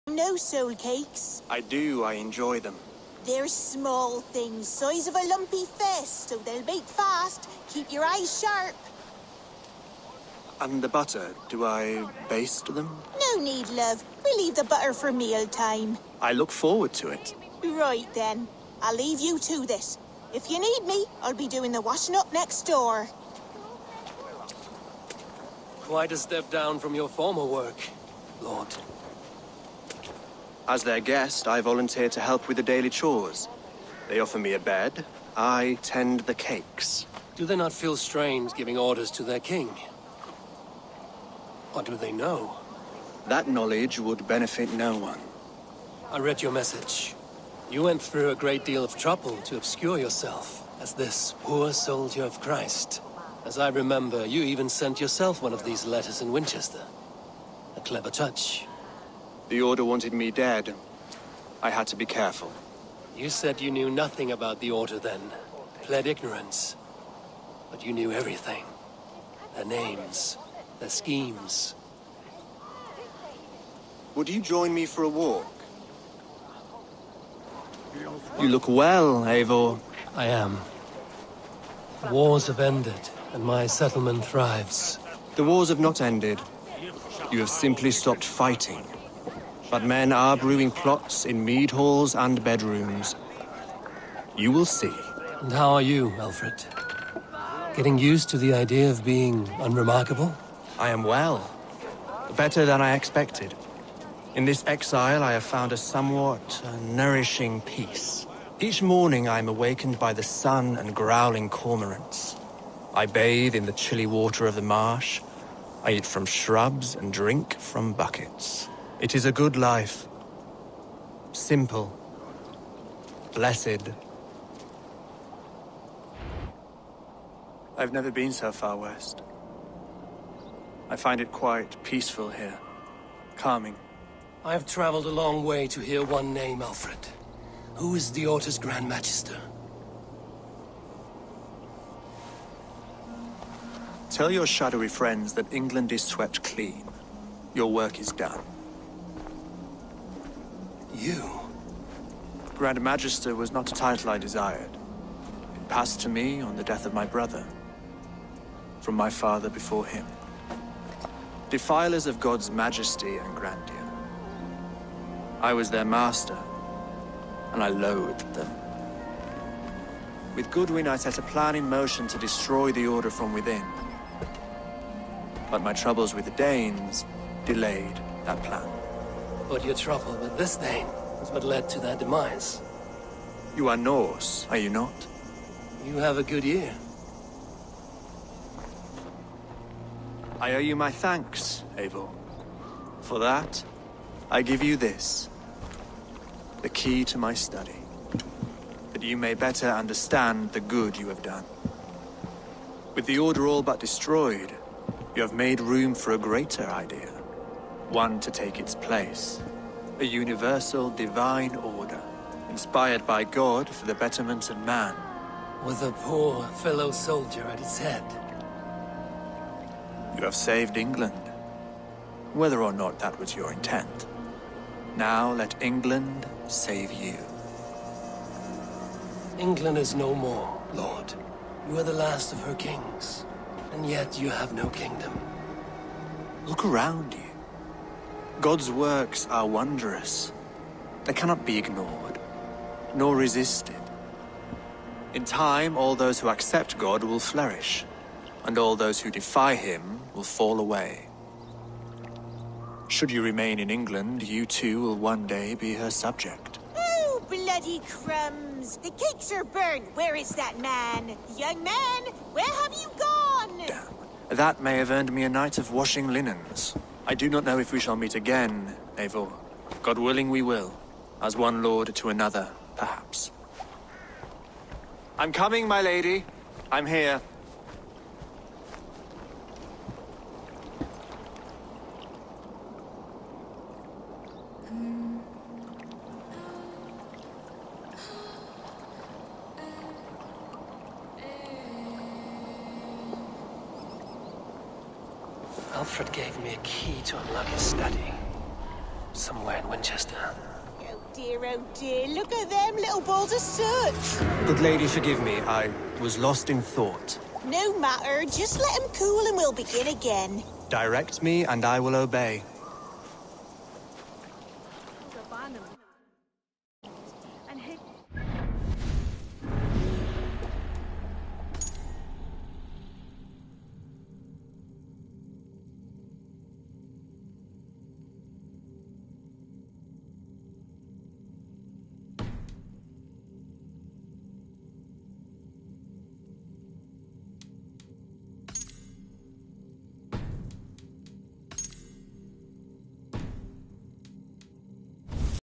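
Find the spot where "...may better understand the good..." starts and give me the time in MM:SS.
03:19.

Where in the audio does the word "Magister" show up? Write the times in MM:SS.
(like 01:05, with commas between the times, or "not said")
02:18, 02:32.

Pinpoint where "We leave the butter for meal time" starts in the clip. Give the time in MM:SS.
00:14.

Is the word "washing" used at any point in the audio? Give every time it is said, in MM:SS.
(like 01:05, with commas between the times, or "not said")
00:21, 04:25.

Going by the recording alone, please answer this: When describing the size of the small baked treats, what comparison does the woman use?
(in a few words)
a lumpy fist.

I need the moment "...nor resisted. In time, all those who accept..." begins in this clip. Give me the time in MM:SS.
04:02.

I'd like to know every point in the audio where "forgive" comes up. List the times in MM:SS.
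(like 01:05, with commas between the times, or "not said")
05:04.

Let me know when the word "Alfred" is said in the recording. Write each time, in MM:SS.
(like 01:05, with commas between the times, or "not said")
01:36, 02:16, 04:55.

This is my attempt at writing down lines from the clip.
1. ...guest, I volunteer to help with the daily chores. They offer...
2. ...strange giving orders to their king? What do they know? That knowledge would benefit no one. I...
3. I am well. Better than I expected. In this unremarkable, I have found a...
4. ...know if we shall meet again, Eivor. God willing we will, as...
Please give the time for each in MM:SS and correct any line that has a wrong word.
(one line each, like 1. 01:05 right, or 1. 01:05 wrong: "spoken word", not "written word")
1. 00:31 right
2. 00:37 right
3. 01:40 wrong: "exile", not "unremarkable"
4. 04:27 right.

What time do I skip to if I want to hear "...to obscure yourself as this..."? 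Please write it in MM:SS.
00:49.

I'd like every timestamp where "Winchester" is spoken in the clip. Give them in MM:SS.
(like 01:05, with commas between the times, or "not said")
00:56, 04:59.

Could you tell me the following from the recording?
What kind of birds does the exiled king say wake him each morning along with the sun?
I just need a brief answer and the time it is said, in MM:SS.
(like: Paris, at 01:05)
cormorants, at 01:51.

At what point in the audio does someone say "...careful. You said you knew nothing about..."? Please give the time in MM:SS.
01:02.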